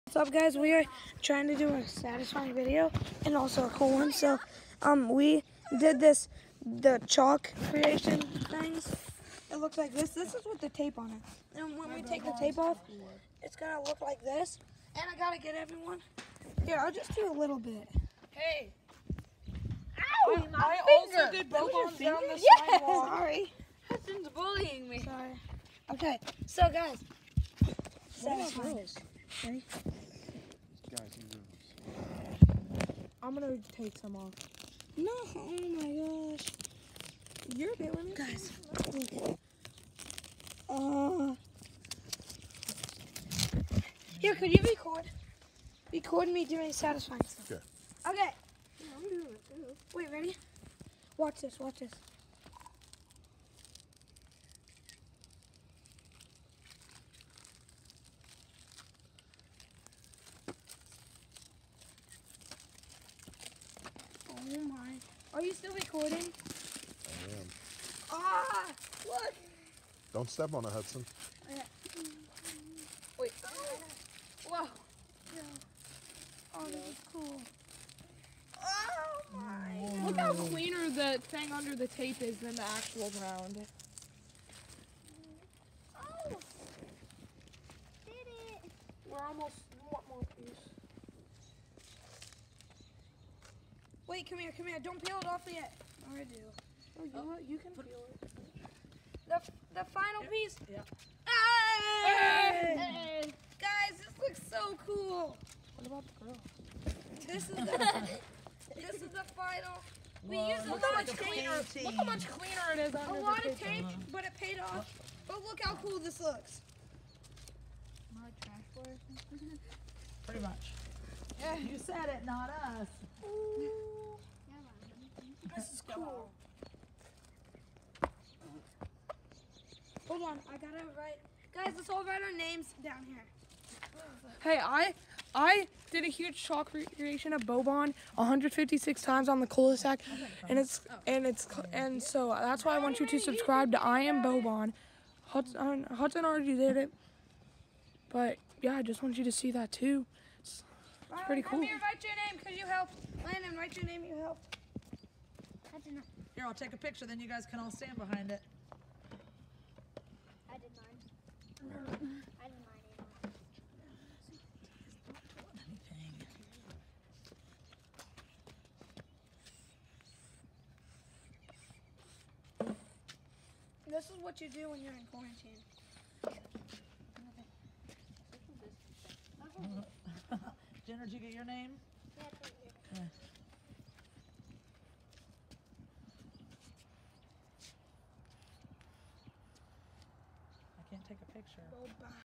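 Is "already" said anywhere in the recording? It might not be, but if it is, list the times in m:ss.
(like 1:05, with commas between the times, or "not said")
2:26.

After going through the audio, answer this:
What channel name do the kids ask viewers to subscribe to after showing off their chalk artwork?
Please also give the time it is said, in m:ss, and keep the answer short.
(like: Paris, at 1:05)
I am Bobon, at 2:23.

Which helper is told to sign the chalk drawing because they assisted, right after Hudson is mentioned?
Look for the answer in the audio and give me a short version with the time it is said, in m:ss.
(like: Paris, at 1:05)
Landon, at 2:33.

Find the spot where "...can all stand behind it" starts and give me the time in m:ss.
2:37.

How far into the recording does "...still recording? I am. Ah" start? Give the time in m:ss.
1:05.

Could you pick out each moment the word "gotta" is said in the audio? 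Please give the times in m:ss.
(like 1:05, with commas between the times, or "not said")
0:15, 2:10.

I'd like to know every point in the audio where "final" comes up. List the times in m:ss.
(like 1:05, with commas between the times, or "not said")
1:39, 1:49.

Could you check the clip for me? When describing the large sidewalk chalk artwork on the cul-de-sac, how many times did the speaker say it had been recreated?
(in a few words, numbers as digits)
156.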